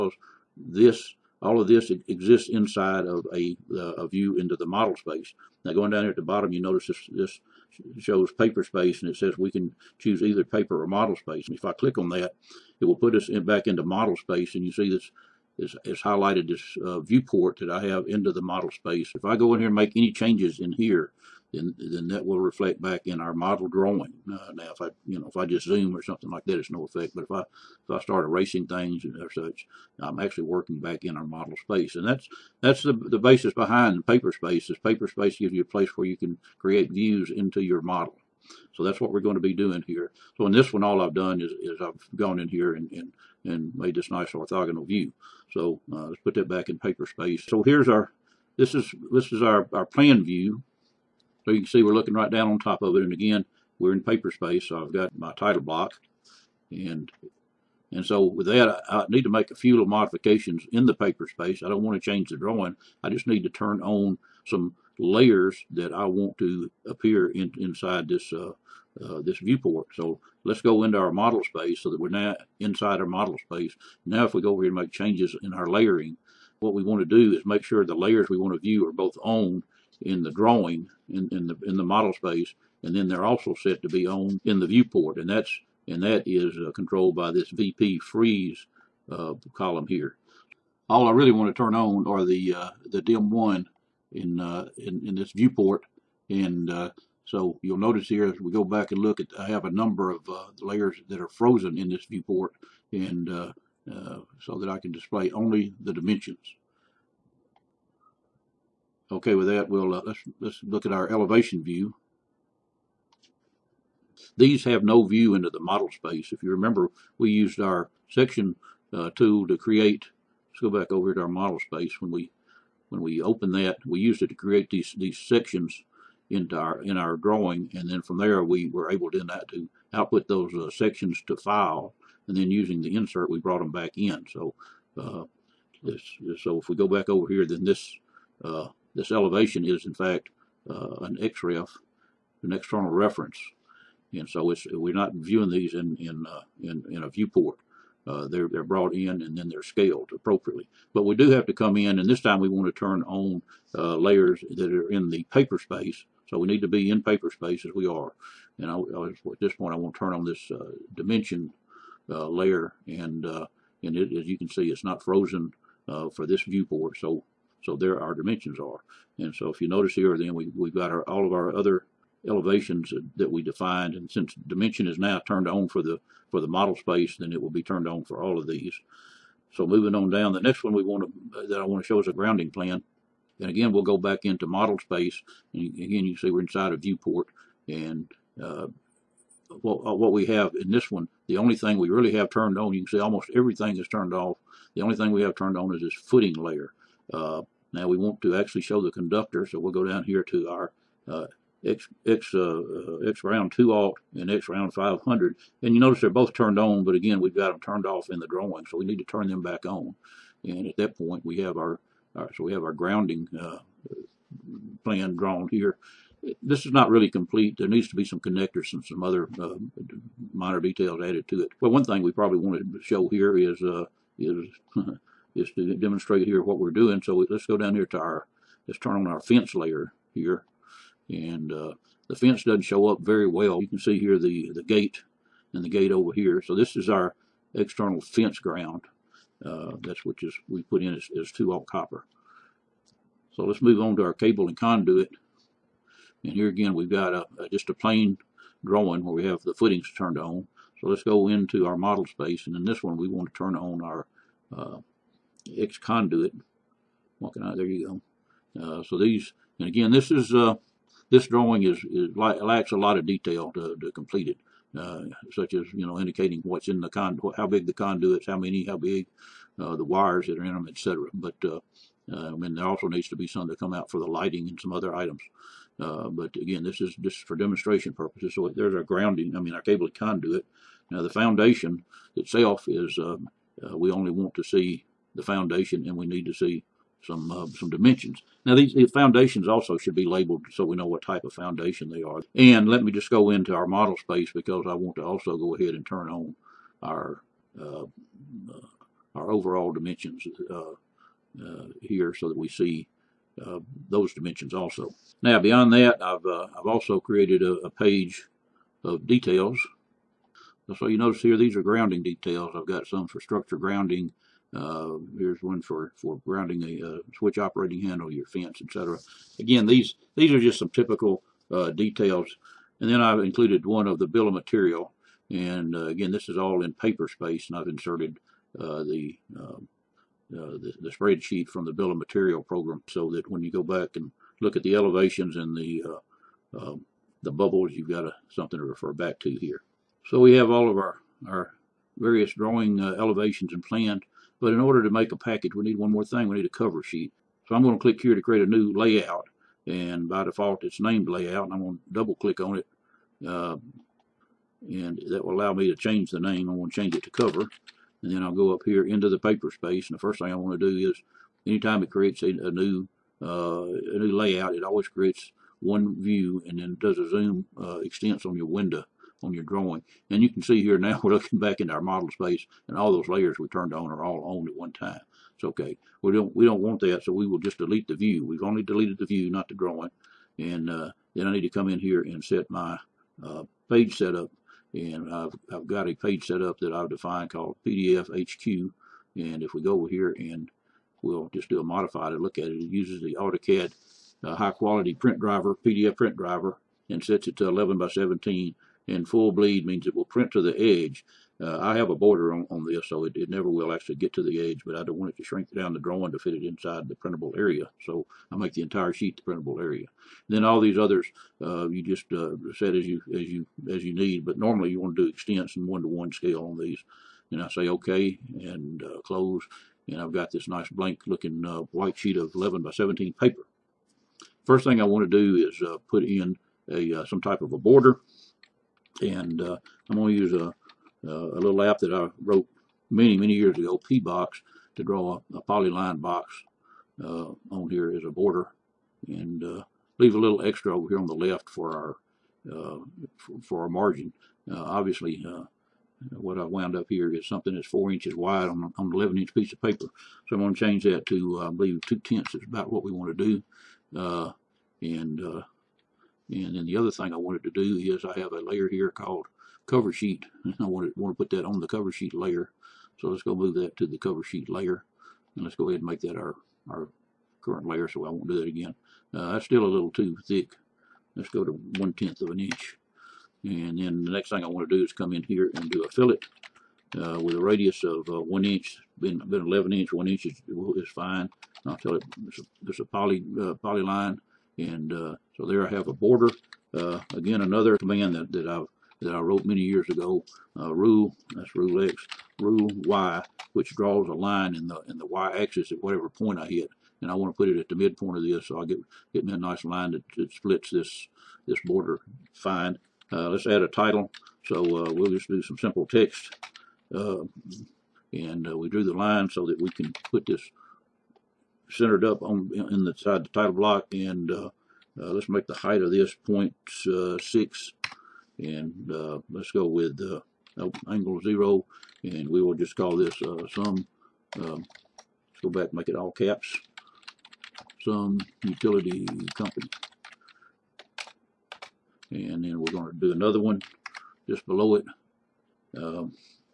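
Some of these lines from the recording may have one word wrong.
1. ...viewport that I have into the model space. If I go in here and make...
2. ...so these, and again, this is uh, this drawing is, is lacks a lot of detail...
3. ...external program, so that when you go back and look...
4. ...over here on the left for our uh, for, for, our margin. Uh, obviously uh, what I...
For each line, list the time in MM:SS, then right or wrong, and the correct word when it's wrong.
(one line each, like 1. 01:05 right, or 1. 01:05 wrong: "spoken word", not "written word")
1. 00:16 right
2. 04:18 right
3. 05:31 wrong: "material", not "external"
4. 07:20 right.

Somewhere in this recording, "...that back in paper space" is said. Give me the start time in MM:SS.
00:46.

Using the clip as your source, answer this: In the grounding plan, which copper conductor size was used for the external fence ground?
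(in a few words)
2 alt.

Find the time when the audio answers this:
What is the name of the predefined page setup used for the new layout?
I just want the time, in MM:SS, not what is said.
06:27.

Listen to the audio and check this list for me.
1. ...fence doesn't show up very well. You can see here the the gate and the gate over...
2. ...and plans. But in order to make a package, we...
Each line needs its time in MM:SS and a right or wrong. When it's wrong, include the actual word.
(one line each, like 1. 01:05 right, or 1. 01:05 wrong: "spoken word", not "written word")
1. 03:52 right
2. 05:43 right.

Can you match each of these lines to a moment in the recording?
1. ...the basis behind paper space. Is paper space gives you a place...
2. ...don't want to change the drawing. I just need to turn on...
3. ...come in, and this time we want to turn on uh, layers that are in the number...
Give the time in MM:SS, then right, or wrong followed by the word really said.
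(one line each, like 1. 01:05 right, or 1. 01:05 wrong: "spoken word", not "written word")
1. 00:32 right
2. 01:01 right
3. 02:31 wrong: "paper", not "number".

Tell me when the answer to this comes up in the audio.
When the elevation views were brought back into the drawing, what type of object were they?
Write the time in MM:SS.
02:21.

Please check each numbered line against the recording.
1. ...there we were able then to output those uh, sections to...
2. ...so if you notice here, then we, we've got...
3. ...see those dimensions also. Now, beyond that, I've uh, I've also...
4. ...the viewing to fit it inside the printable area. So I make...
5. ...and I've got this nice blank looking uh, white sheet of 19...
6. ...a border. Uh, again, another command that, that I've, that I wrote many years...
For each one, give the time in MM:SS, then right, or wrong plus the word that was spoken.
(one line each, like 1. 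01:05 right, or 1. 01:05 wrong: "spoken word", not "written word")
1. 02:08 right
2. 02:49 right
3. 05:02 right
4. 06:45 wrong: "drawing", not "viewing"
5. 06:59 wrong: "11", not "19"
6. 08:05 right.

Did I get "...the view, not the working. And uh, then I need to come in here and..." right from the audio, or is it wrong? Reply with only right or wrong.
wrong.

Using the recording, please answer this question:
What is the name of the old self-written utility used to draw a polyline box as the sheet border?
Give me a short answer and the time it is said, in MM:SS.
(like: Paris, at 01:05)
P-Box, at 07:13.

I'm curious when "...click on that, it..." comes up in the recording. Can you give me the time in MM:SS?
00:11.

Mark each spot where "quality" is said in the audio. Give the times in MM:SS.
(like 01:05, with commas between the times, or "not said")
06:34.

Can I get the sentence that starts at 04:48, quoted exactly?
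Now these, foundations also should be labeled so we know what type of foundation they are.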